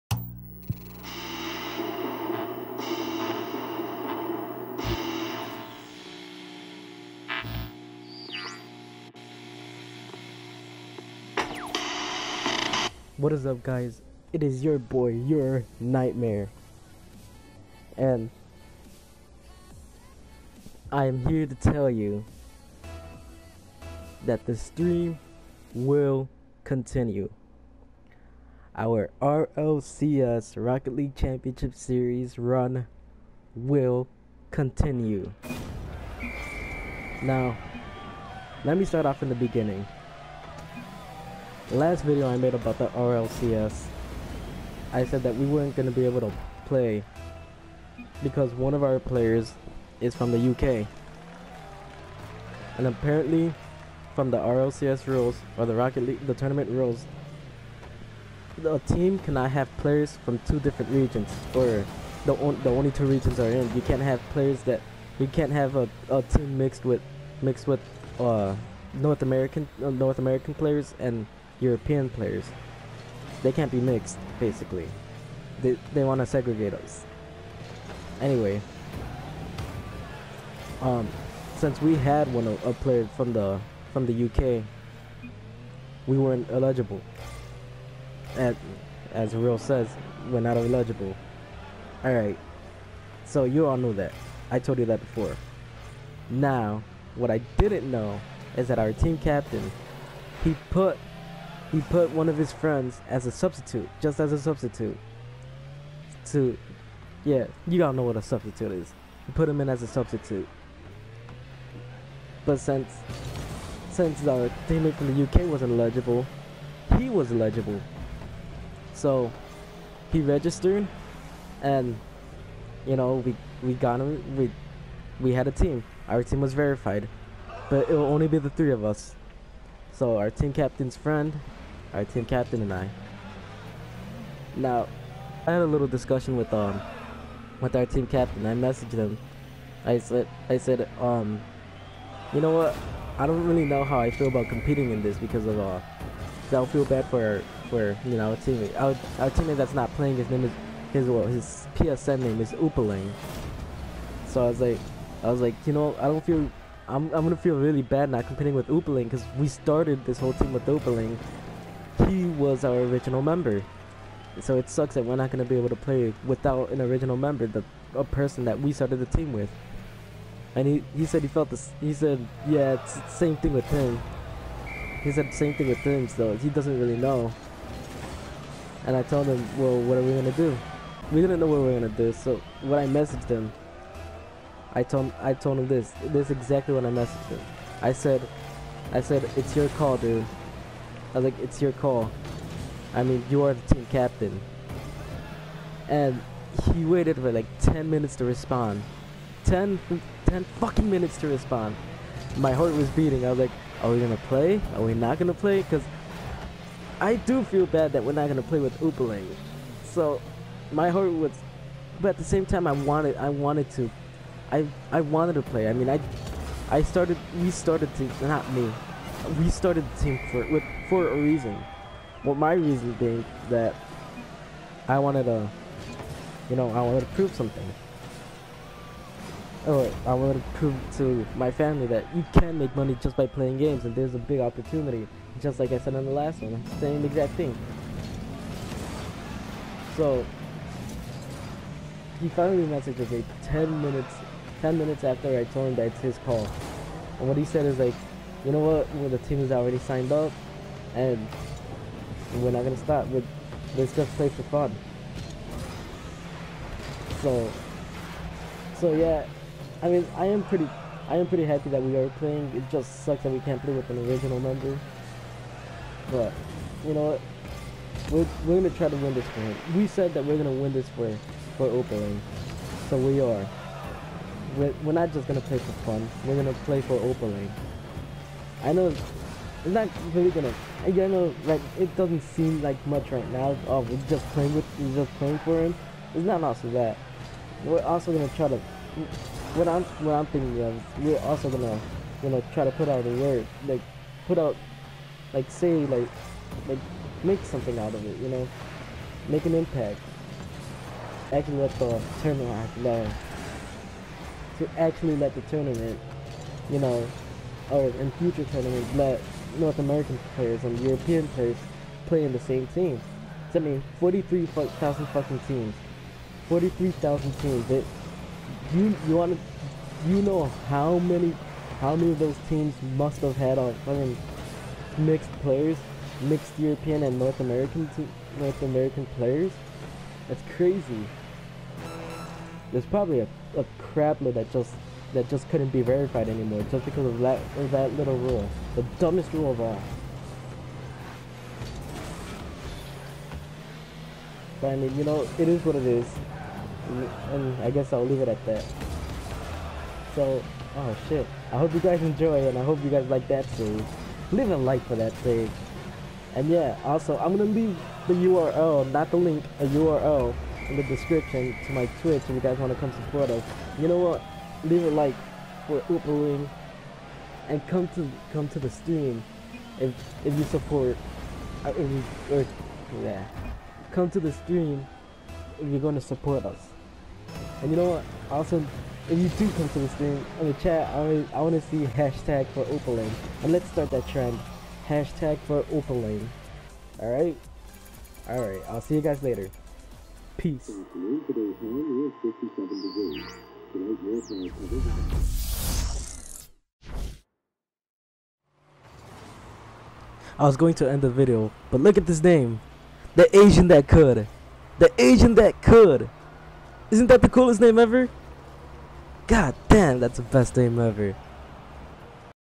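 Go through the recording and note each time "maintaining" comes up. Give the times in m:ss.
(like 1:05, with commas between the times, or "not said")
not said.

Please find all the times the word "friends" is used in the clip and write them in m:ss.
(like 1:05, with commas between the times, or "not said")
1:42, 2:10.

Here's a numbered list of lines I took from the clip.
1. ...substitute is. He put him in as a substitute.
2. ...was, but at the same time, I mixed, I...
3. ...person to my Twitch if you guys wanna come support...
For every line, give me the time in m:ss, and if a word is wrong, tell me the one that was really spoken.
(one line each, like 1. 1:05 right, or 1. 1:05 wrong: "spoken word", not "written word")
1. 1:48 right
2. 3:31 wrong: "wanted", not "mixed"
3. 6:00 wrong: "description", not "person".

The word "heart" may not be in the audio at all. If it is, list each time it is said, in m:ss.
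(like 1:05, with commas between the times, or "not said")
3:22, 3:30.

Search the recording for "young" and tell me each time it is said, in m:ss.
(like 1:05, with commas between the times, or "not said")
not said.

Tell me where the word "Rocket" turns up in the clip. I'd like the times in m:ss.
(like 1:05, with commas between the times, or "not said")
0:30, 0:55.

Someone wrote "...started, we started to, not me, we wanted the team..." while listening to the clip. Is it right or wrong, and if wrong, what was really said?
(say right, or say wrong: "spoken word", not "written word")
wrong: "started", not "wanted".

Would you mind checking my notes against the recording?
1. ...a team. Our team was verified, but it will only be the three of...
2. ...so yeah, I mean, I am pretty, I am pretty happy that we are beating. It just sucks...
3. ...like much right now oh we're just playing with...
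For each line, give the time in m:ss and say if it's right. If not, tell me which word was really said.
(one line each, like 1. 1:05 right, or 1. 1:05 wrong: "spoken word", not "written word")
1. 2:05 right
2. 4:18 wrong: "playing", not "beating"
3. 4:42 right.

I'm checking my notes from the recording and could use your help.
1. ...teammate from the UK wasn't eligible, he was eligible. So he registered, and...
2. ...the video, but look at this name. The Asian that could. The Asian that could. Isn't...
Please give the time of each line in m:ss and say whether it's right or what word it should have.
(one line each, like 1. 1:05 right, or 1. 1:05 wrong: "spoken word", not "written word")
1. 1:54 right
2. 6:41 right.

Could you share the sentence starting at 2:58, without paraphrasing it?
And I told him, well, what are we going to do?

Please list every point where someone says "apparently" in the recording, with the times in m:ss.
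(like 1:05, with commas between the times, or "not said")
0:52.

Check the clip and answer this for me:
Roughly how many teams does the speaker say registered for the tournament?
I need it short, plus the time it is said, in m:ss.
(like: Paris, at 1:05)
43,000, at 5:16.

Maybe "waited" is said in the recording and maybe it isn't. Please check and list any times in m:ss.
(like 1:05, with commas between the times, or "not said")
3:16.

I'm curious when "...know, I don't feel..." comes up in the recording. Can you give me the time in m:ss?
2:35.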